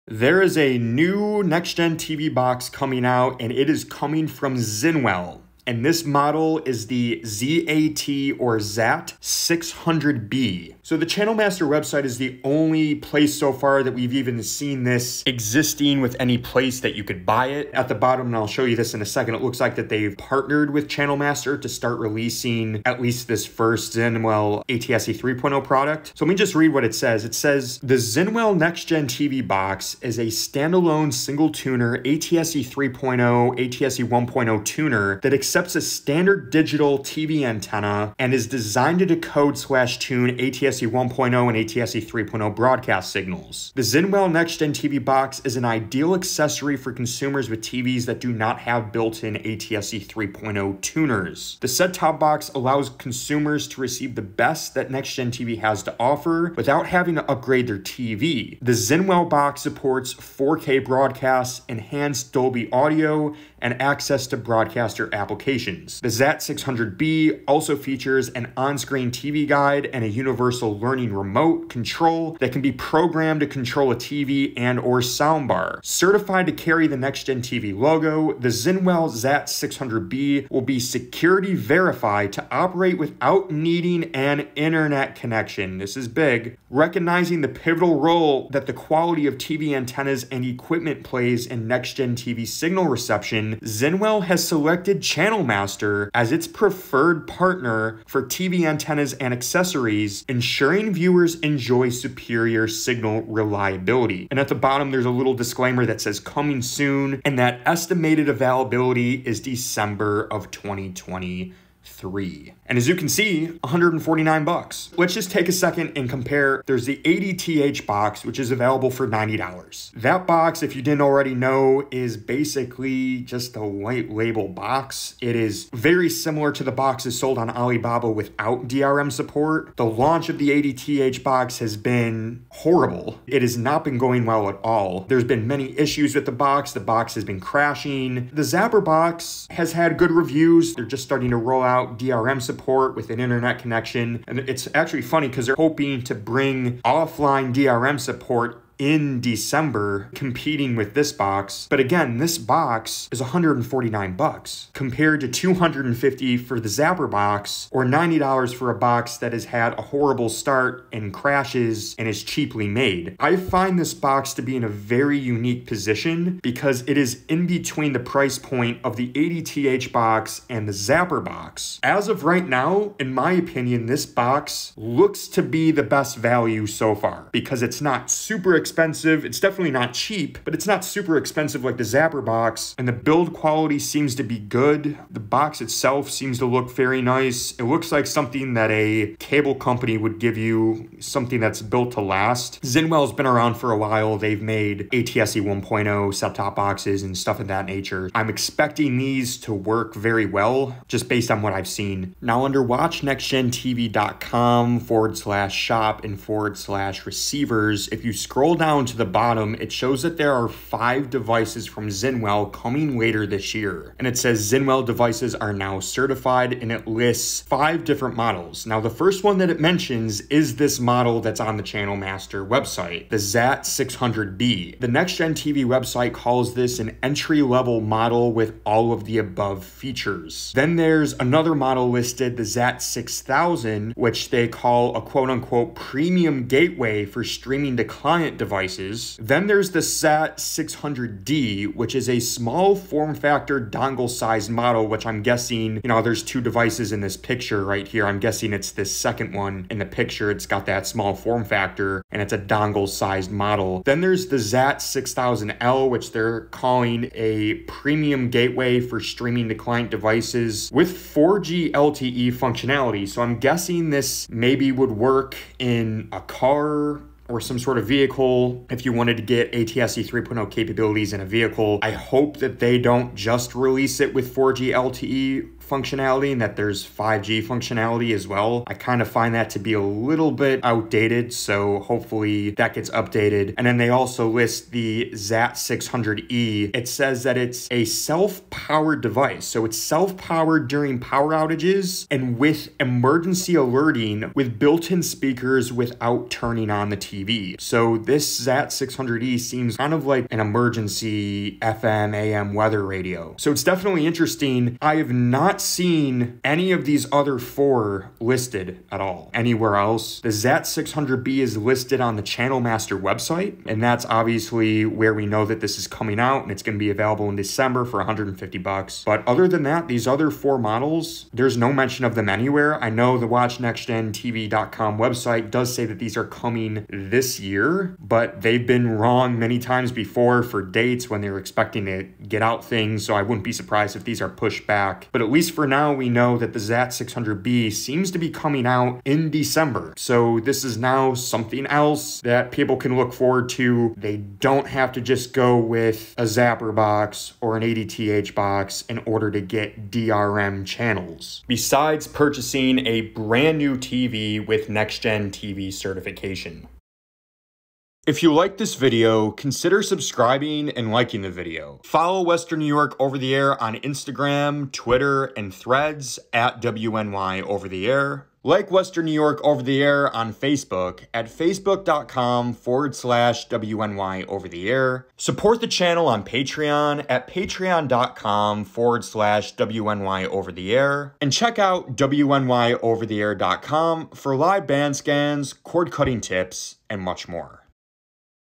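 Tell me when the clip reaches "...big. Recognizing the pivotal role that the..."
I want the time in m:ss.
1:26.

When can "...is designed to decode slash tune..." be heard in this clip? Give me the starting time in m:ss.
0:38.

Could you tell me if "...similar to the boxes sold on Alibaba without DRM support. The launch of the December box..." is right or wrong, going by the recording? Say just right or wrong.
wrong.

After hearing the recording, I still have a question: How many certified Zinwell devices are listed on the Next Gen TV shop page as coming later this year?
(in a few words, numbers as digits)
5.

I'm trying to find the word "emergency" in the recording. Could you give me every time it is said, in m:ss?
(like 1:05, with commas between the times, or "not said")
4:52, 5:00.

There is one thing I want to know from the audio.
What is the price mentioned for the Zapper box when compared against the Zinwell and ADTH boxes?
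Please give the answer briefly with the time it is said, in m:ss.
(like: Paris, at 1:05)
$250, at 2:35.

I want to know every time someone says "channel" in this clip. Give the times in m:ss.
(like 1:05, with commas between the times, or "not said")
0:11, 0:20, 1:35, 3:41, 5:12, 5:50, 6:15.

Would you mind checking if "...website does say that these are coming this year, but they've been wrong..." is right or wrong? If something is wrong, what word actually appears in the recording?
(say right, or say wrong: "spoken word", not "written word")
right.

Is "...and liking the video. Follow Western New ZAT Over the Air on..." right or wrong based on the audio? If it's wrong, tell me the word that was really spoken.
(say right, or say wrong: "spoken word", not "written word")
wrong: "York", not "ZAT".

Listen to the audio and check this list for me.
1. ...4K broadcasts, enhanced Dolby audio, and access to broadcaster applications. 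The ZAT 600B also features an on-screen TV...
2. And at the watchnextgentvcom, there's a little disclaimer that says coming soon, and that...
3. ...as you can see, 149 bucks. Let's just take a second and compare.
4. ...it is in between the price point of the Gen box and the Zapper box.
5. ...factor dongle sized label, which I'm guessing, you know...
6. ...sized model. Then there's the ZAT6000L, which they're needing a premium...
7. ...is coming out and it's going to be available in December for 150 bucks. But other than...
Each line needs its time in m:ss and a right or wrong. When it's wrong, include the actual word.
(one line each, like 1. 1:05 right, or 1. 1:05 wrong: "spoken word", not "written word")
1. 1:00 right
2. 1:44 wrong: "bottom", not "watchnextgentvcom"
3. 1:52 right
4. 2:46 wrong: "ADTH", not "Gen"
5. 4:03 wrong: "model", not "label"
6. 4:12 wrong: "calling", not "needing"
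7. 5:15 right.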